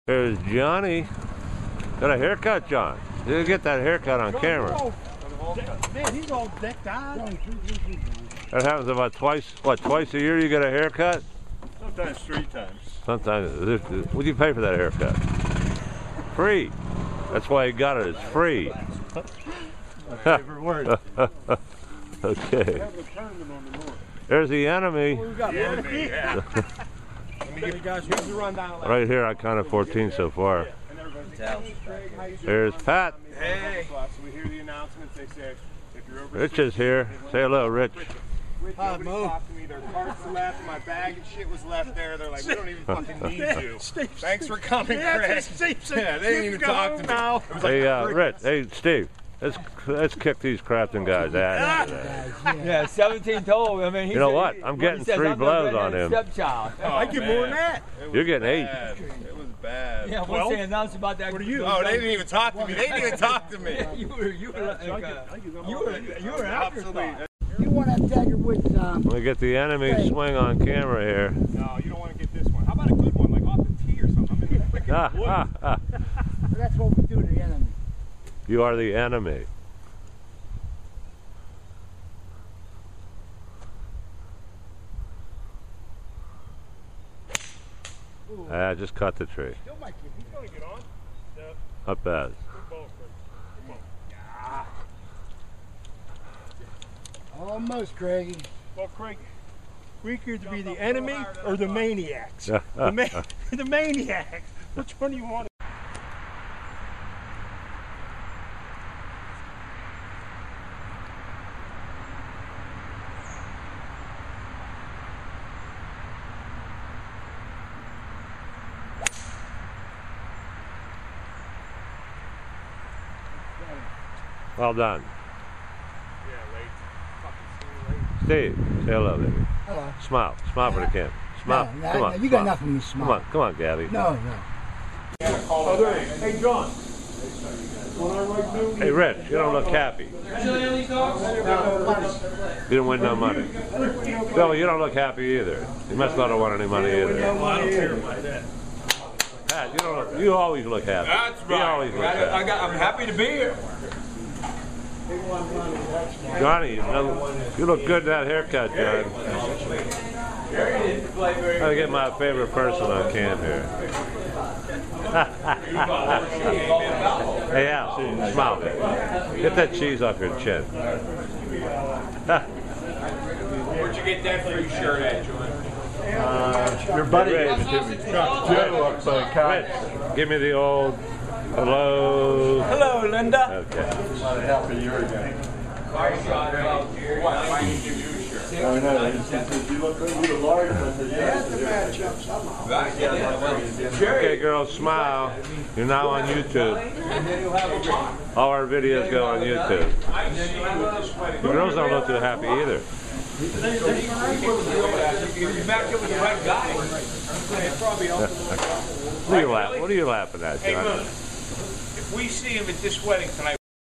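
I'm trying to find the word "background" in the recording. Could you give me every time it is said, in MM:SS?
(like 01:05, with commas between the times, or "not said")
not said.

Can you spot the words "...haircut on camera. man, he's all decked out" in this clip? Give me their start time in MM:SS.
00:03.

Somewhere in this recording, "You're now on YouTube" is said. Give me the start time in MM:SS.
03:15.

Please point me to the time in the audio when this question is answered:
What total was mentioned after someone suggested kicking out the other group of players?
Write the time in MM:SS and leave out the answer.
00:52.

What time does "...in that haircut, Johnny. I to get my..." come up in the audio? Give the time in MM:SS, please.
02:38.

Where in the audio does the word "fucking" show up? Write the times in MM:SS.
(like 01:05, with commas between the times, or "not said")
00:42, 02:08.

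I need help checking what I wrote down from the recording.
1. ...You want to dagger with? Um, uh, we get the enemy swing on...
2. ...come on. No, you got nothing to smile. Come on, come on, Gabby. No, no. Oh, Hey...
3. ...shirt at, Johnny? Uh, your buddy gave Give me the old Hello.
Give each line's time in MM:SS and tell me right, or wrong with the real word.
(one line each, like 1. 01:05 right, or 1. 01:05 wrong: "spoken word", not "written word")
1. 01:07 right
2. 02:11 right
3. 02:54 right.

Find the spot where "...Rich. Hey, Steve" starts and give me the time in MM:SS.
00:48.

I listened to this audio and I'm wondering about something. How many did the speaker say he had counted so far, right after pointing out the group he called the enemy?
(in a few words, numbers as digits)
14.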